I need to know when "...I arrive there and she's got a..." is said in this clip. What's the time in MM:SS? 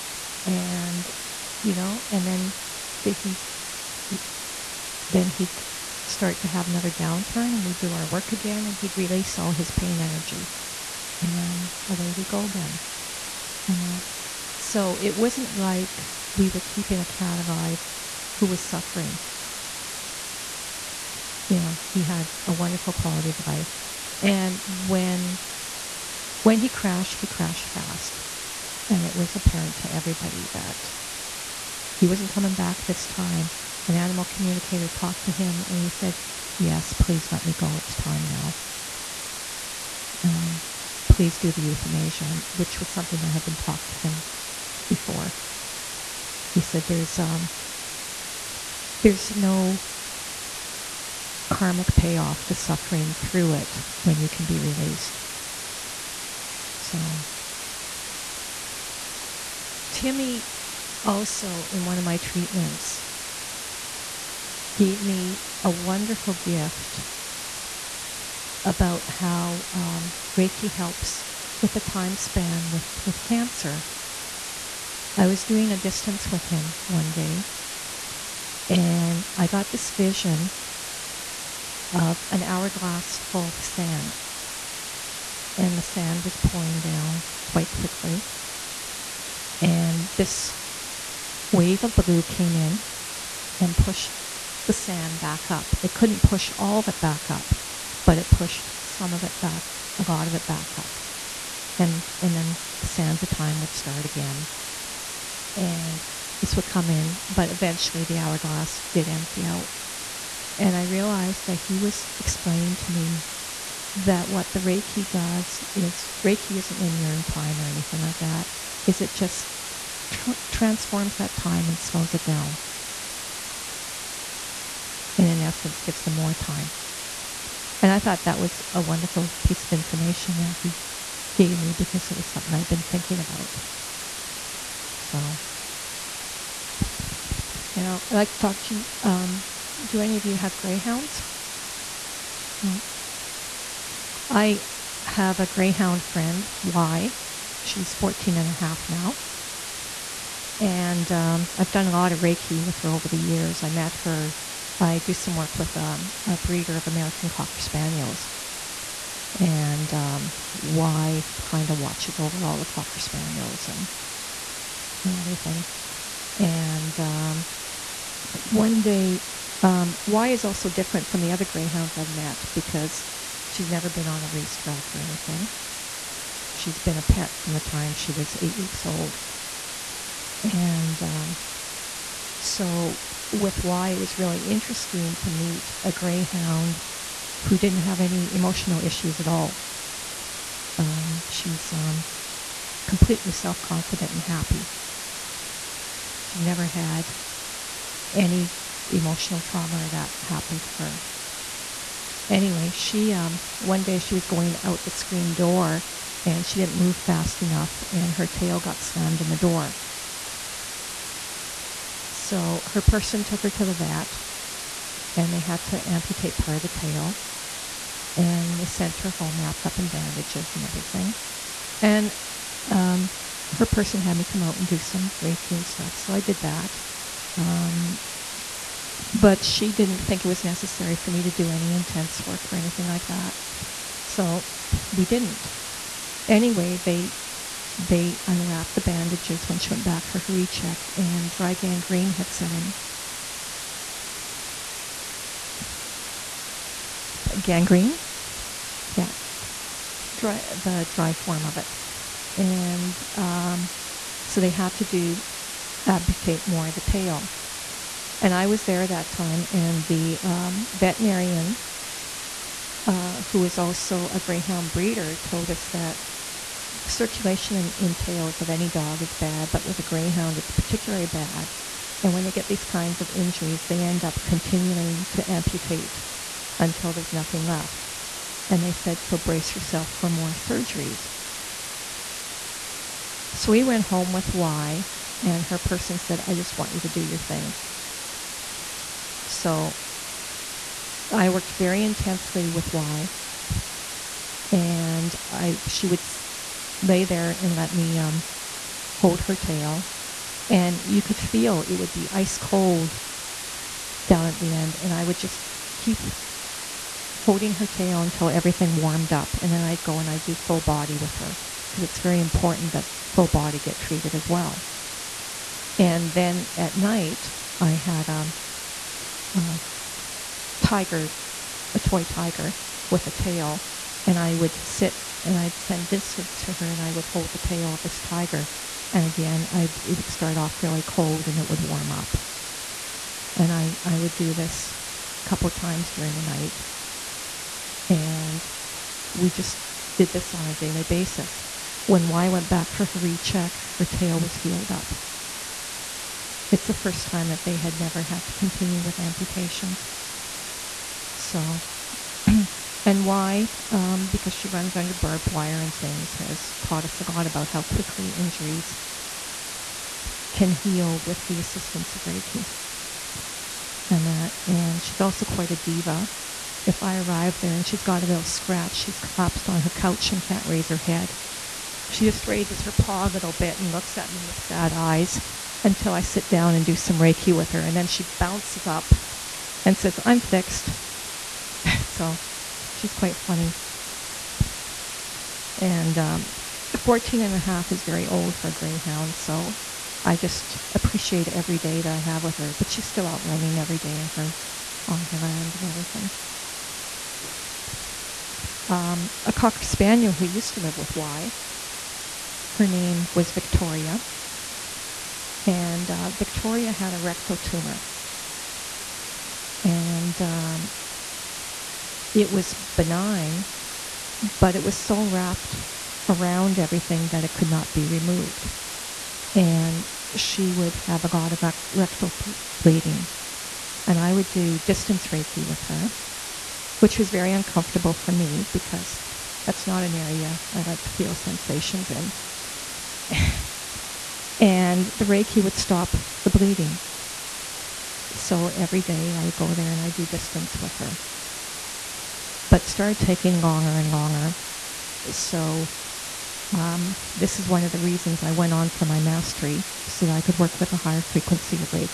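06:06.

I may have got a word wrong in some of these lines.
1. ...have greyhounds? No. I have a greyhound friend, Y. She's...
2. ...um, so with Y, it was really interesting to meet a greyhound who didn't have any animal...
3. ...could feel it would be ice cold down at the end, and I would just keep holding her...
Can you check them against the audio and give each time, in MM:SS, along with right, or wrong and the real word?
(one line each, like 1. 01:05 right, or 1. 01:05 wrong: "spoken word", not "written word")
1. 02:20 right
2. 03:01 wrong: "emotional", not "animal"
3. 05:01 right.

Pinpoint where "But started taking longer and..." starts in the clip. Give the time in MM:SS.
07:22.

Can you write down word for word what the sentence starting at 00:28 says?
And it was apparent to everybody that he wasn't coming back this time.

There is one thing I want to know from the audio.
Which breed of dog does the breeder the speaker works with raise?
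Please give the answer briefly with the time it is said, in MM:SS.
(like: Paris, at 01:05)
American Cocker Spaniels, at 02:36.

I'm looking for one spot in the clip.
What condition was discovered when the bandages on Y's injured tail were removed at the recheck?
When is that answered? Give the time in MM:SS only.
04:01.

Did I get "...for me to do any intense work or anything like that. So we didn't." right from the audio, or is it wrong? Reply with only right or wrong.
right.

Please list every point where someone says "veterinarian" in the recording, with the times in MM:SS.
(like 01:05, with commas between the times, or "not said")
04:20.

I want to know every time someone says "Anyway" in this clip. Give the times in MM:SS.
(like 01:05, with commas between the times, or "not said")
03:22, 03:56.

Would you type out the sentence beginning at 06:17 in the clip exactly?
And then she bounces up and says, I'm fixed.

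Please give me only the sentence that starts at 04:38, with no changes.
And they said, so brace yourself for more surgeries.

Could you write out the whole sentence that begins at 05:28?
And again, I, it would start off really cold and it would warm up.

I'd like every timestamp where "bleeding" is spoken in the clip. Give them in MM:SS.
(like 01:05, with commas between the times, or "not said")
07:02, 07:16.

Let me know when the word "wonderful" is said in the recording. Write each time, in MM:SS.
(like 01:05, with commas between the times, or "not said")
00:22, 01:05, 02:08.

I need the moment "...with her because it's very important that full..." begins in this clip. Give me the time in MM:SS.
05:10.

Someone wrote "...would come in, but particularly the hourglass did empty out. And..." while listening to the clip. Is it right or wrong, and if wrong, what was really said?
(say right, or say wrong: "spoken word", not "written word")
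wrong: "eventually", not "particularly".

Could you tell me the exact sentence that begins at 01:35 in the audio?
It couldn't push all of it back up, but it pushed some of it back, a lot of it back up.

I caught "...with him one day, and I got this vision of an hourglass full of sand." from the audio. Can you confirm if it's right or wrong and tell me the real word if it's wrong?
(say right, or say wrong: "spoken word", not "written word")
right.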